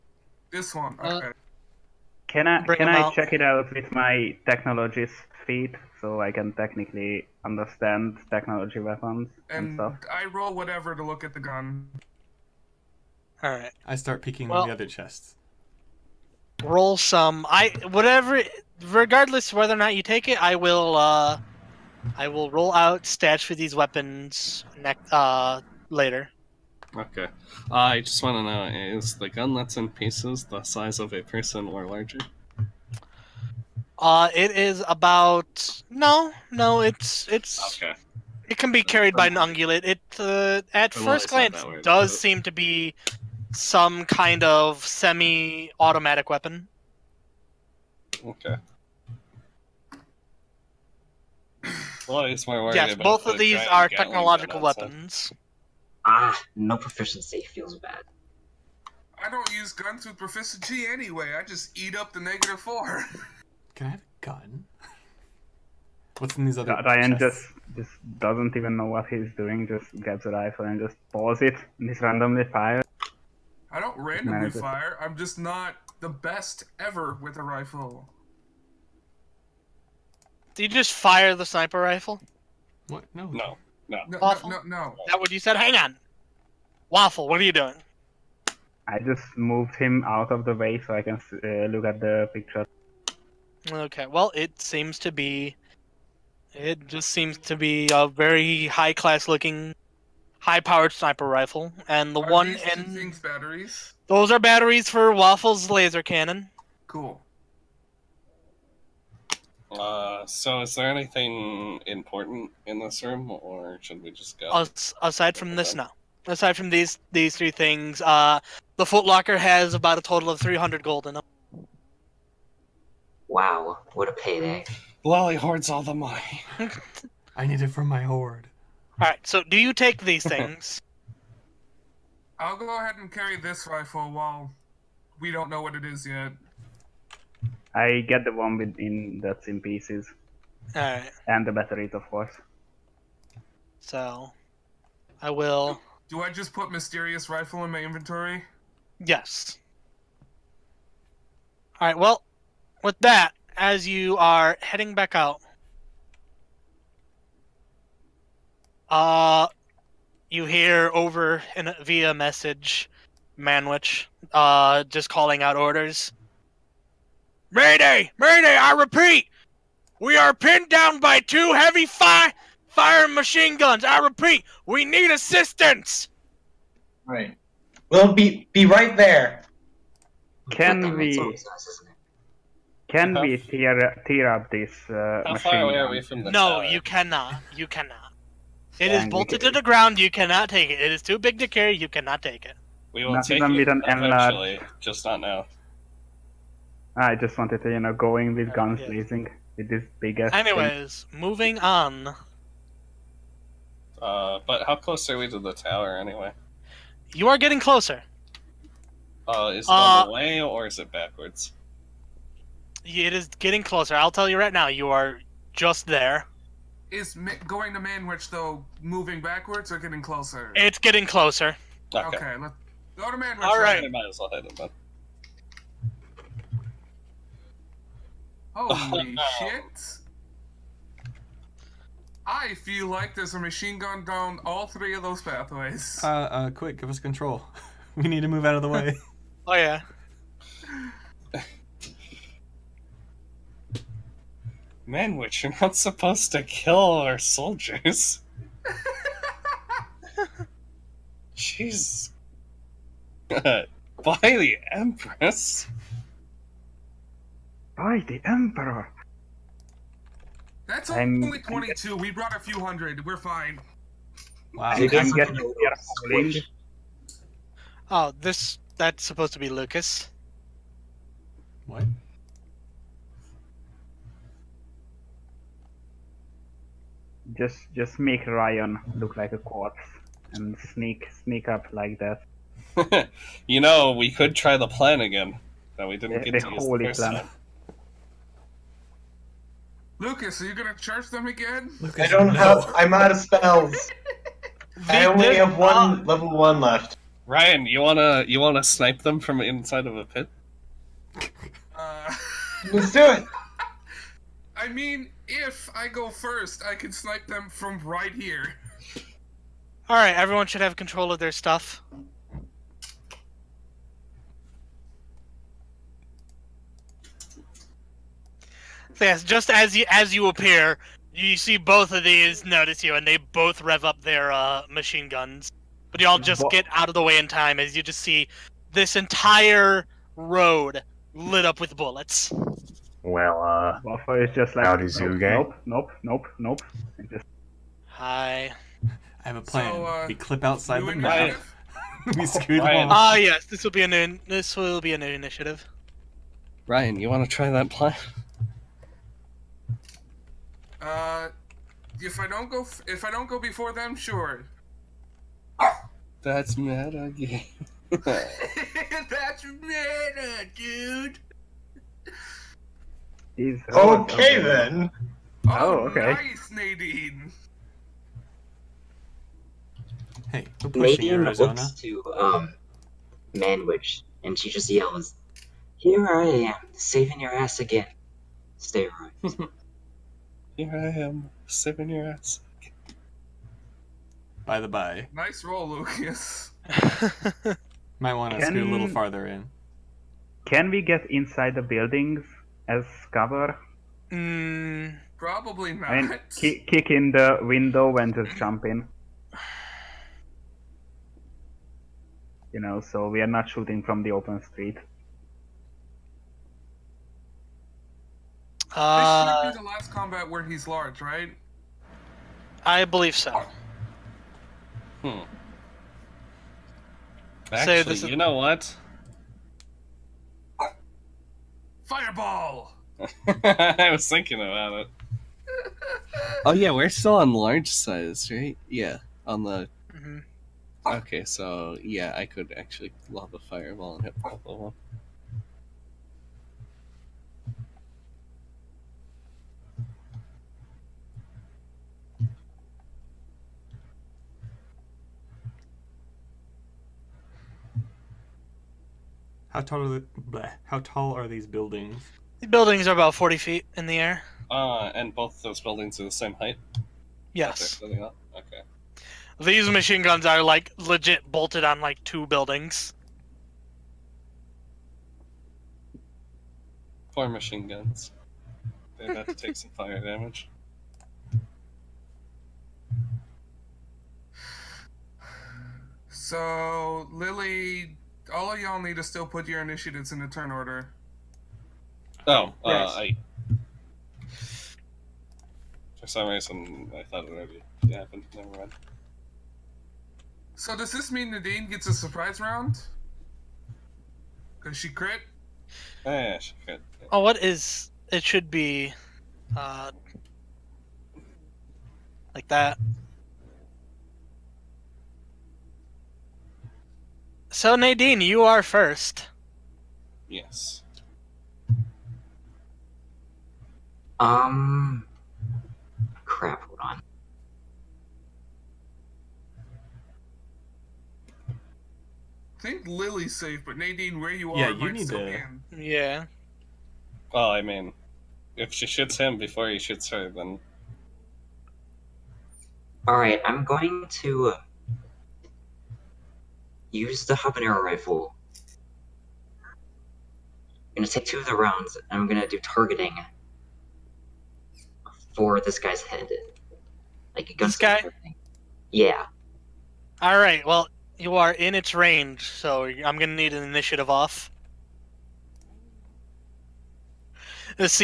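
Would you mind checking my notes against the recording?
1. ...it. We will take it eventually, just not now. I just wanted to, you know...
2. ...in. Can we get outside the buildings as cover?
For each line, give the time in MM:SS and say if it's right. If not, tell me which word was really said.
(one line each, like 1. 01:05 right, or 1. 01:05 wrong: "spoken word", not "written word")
1. 03:12 right
2. 06:29 wrong: "inside", not "outside".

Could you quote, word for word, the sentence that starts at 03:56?
Uh, uh, quick, give us control.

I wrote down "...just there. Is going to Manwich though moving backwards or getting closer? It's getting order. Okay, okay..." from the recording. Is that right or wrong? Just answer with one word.
wrong.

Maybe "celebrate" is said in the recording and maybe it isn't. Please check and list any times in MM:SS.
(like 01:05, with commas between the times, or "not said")
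not said.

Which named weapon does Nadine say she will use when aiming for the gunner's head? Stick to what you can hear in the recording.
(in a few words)
Habanero rifle.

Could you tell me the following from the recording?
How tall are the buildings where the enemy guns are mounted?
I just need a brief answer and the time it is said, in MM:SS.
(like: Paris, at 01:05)
40 feet, at 07:33.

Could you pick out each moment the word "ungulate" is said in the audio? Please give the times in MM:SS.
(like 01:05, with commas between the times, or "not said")
00:39.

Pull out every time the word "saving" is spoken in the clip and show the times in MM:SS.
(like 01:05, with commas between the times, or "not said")
06:16, 06:21.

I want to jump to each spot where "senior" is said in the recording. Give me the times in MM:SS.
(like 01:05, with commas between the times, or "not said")
not said.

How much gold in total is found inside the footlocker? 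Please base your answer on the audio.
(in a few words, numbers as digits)
300 gold.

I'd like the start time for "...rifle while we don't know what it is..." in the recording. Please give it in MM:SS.
02:13.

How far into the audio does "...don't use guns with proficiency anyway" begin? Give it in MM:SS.
00:59.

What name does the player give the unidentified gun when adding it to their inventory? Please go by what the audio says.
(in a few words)
Mysterious rifle.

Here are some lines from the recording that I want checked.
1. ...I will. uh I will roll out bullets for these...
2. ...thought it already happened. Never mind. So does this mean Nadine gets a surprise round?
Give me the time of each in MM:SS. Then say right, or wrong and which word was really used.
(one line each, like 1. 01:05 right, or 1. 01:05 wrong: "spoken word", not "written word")
1. 00:20 wrong: "stats", not "bullets"
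2. 08:07 right.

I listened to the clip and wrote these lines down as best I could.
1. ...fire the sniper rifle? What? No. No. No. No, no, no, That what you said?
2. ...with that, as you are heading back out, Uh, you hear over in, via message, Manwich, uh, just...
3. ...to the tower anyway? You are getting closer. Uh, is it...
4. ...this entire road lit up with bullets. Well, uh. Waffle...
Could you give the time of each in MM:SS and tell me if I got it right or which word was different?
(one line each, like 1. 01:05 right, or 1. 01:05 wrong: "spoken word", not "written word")
1. 01:20 right
2. 02:32 right
3. 03:25 right
4. 05:28 right.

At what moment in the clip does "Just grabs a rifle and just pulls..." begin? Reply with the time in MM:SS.
01:09.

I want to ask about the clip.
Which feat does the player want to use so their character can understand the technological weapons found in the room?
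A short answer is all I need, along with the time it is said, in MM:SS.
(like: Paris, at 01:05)
Technologist, at 00:04.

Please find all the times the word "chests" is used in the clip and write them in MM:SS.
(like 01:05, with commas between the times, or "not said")
00:14, 01:07.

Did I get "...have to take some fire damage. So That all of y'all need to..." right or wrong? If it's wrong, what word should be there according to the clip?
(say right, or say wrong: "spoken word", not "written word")
wrong: "Lily", not "That".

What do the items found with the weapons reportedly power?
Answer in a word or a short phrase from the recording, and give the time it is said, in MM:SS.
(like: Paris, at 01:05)
Waffle's laser cannon, at 01:45.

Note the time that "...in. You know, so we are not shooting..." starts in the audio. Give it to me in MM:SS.
06:38.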